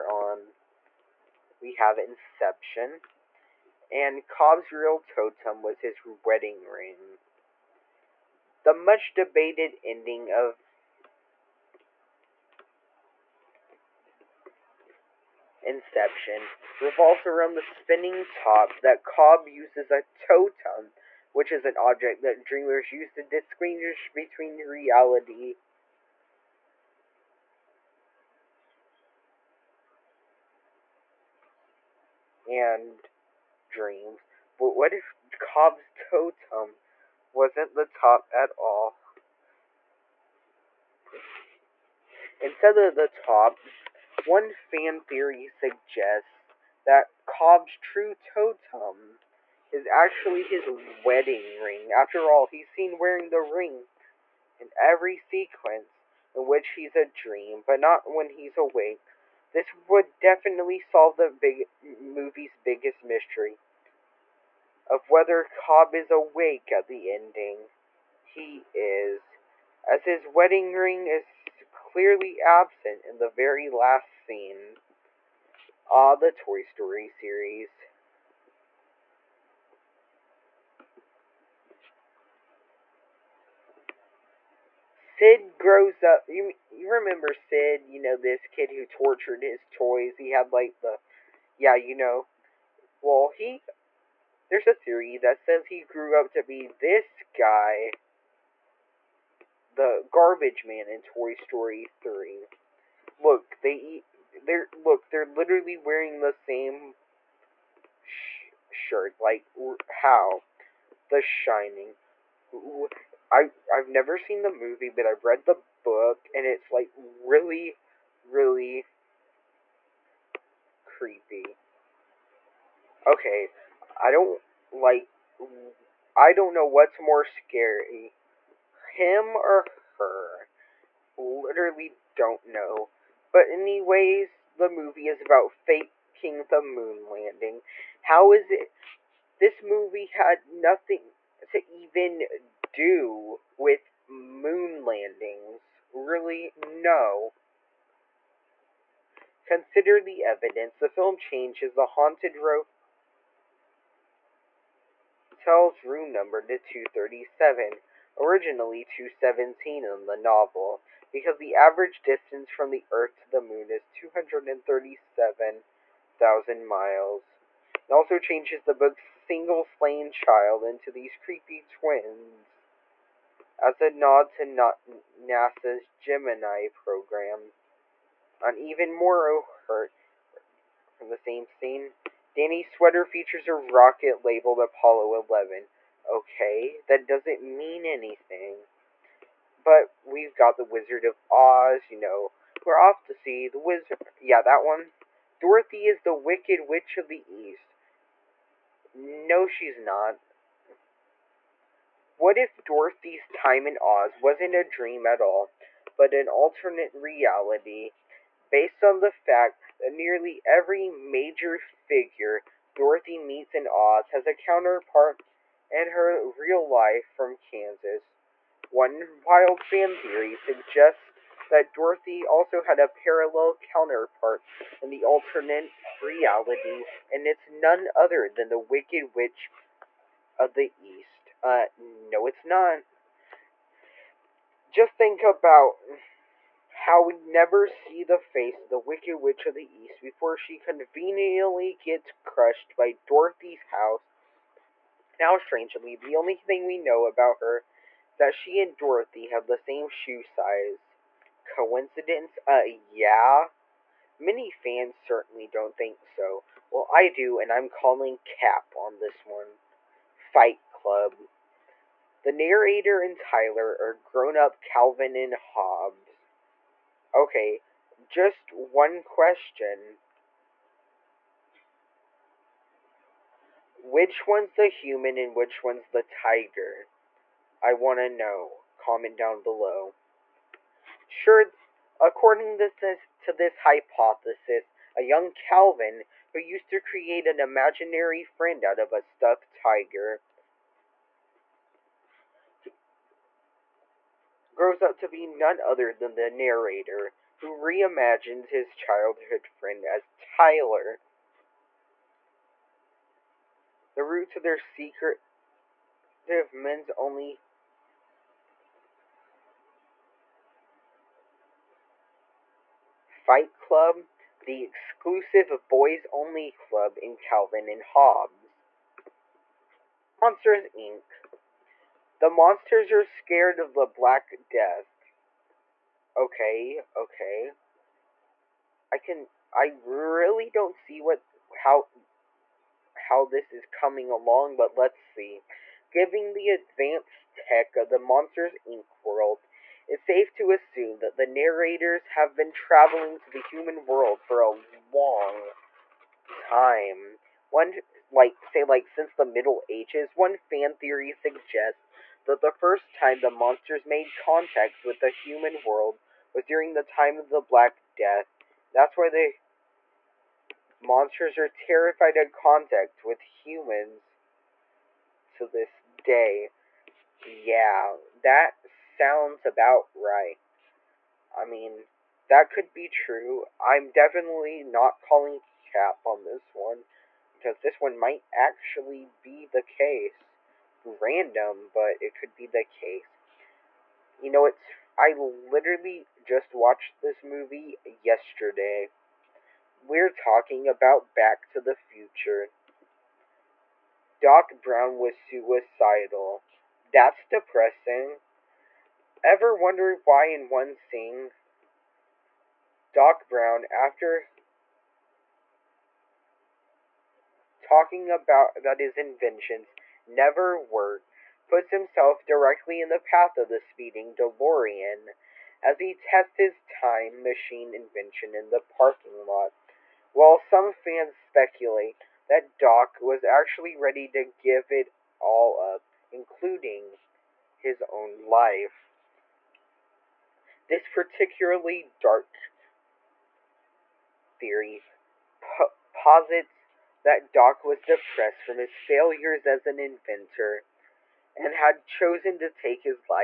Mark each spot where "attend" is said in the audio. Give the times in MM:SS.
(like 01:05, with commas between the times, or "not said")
not said.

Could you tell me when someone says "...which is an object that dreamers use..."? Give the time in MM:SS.
00:21.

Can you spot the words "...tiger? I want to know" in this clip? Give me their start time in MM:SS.
04:36.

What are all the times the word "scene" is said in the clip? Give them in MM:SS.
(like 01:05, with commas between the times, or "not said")
01:14, 03:01, 06:40.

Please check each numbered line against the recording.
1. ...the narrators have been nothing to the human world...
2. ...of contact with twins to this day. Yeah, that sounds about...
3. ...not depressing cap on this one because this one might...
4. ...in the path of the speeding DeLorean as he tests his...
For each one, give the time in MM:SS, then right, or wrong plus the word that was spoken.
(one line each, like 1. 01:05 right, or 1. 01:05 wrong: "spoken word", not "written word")
1. 05:41 wrong: "traveling", not "nothing"
2. 06:02 wrong: "humans", not "twins"
3. 06:14 wrong: "calling", not "depressing"
4. 06:52 right.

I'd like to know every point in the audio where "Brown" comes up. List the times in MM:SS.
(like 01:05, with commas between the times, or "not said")
06:34, 06:43.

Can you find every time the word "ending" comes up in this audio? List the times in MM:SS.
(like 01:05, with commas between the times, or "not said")
00:09, 01:07.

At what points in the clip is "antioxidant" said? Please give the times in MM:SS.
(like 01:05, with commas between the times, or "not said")
not said.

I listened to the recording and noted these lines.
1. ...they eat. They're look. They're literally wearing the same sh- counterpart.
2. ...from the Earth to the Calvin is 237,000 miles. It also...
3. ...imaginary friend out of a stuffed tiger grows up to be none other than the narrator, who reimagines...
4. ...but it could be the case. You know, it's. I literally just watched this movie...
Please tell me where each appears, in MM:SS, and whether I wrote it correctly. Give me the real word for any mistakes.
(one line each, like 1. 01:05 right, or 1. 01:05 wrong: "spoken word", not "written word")
1. 01:43 wrong: "shirt", not "counterpart"
2. 02:42 wrong: "Moon", not "Calvin"
3. 04:47 right
4. 06:21 right.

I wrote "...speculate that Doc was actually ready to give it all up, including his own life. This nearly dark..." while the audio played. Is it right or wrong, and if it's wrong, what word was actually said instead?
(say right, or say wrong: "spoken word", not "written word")
wrong: "particularly", not "nearly".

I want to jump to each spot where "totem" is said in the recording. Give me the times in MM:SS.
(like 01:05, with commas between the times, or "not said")
00:04, 00:20, 00:35, 00:48.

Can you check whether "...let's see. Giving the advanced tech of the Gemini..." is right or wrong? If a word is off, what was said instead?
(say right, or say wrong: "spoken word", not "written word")
wrong: "Monsters", not "Gemini".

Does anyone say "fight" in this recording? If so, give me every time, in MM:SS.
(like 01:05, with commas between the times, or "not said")
04:20, 05:13.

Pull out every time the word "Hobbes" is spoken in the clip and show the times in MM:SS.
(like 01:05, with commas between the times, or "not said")
04:25, 05:17.